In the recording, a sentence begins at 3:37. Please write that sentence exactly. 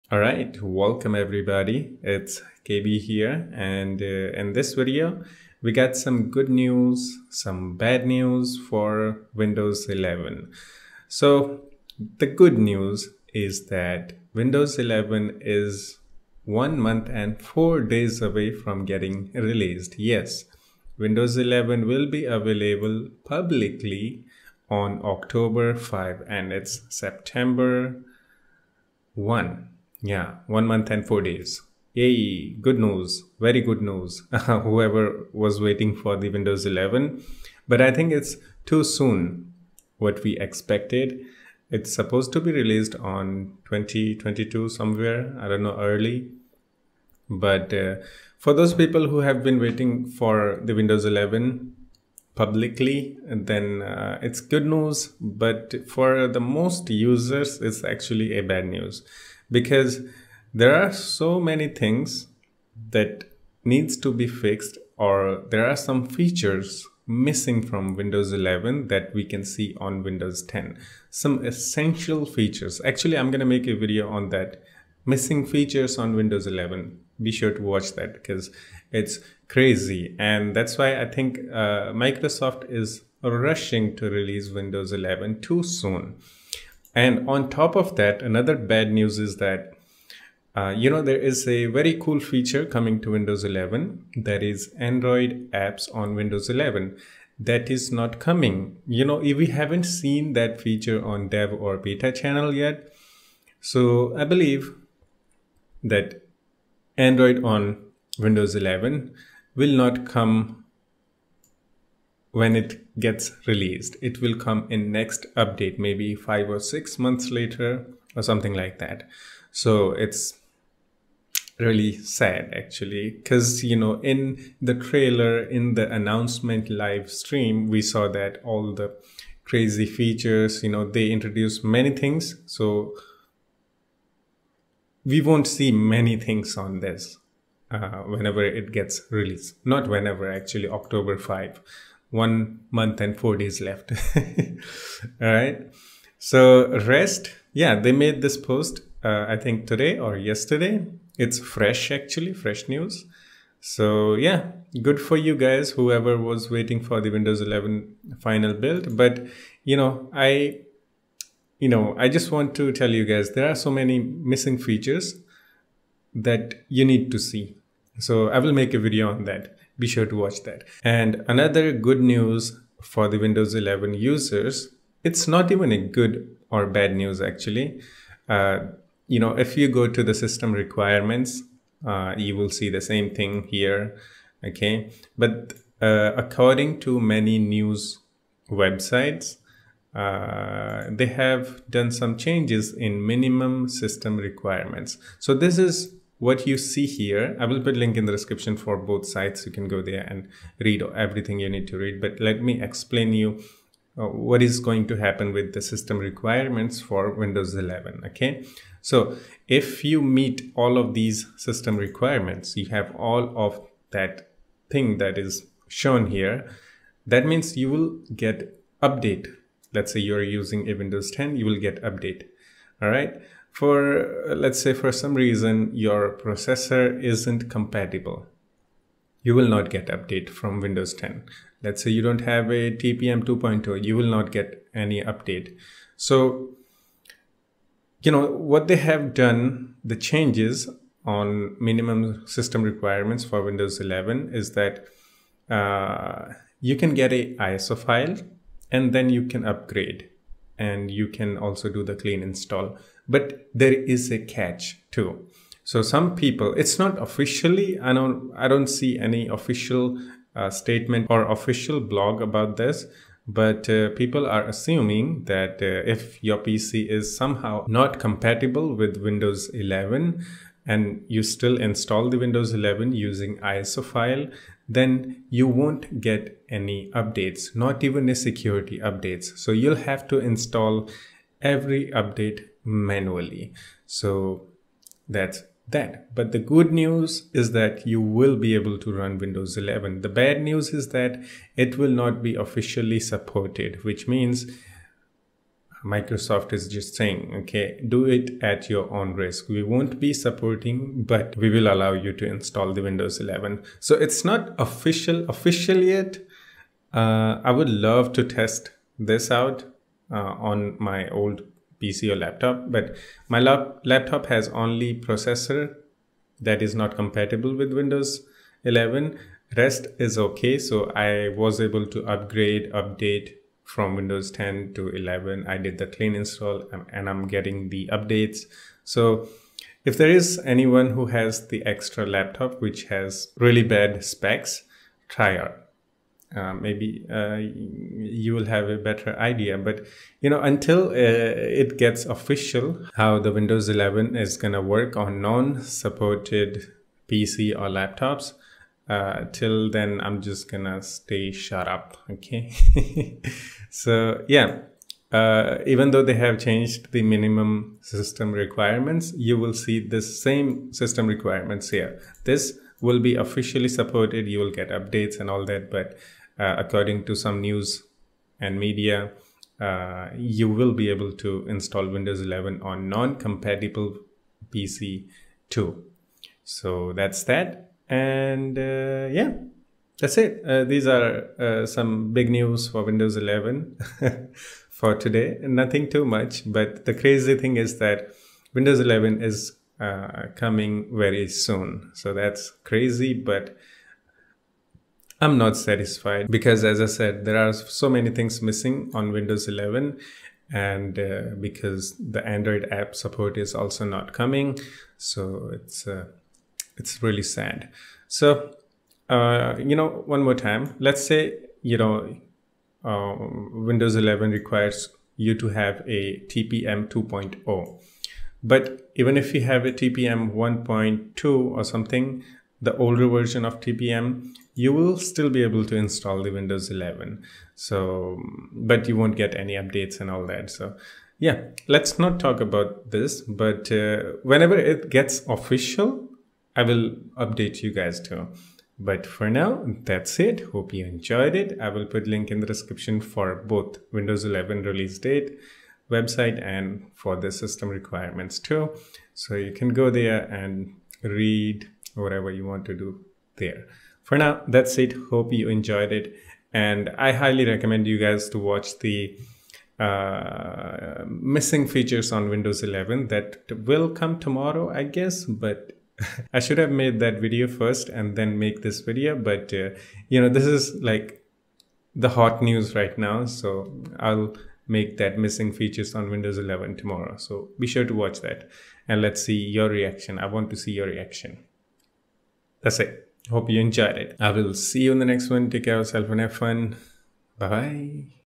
That means you will get update.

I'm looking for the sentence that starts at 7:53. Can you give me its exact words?
So I'll make that missing features on Windows 11 tomorrow.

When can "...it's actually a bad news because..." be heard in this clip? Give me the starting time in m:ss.
0:57.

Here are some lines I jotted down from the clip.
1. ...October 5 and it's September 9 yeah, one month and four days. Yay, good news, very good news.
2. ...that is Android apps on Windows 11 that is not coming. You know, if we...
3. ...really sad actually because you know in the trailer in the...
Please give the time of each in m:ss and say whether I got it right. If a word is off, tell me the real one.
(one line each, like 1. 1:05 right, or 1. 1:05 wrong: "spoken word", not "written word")
1. 0:25 wrong: "1", not "9"
2. 1:34 right
3. 2:01 right.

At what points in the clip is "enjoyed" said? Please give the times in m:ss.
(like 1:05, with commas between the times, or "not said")
7:20, 7:35, 8:03.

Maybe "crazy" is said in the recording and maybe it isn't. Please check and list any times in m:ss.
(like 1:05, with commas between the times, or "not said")
1:19, 2:09, 6:26, 6:32.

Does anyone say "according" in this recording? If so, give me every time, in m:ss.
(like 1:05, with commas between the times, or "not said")
3:06, 6:06.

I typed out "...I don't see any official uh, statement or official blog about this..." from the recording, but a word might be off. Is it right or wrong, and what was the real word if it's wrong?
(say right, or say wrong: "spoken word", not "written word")
right.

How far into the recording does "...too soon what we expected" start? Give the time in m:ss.
0:38.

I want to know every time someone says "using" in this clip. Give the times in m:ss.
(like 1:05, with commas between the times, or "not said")
3:40, 4:32.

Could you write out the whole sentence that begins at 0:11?
So the good news is that Windows 11 is one month and four days away from getting released.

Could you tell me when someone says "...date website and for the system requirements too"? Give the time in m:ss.
7:24.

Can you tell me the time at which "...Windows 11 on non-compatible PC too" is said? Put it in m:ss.
6:11.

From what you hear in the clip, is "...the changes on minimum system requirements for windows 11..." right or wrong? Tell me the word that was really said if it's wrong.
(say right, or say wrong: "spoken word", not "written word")
right.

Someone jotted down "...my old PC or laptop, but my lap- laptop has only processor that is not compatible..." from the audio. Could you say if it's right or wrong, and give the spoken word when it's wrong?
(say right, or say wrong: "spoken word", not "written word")
right.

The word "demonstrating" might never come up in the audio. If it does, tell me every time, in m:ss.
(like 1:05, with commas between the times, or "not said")
not said.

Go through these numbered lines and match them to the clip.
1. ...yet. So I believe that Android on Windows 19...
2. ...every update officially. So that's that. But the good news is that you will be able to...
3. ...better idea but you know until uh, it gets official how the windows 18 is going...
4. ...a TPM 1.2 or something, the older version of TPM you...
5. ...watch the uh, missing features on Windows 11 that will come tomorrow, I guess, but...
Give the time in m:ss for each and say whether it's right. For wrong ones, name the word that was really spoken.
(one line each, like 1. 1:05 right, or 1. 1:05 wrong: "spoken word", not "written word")
1. 1:42 wrong: "11", not "19"
2. 4:41 wrong: "manually", not "officially"
3. 5:38 wrong: "11", not "18"
4. 6:59 right
5. 7:38 right.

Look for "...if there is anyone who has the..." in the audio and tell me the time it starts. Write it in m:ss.
5:29.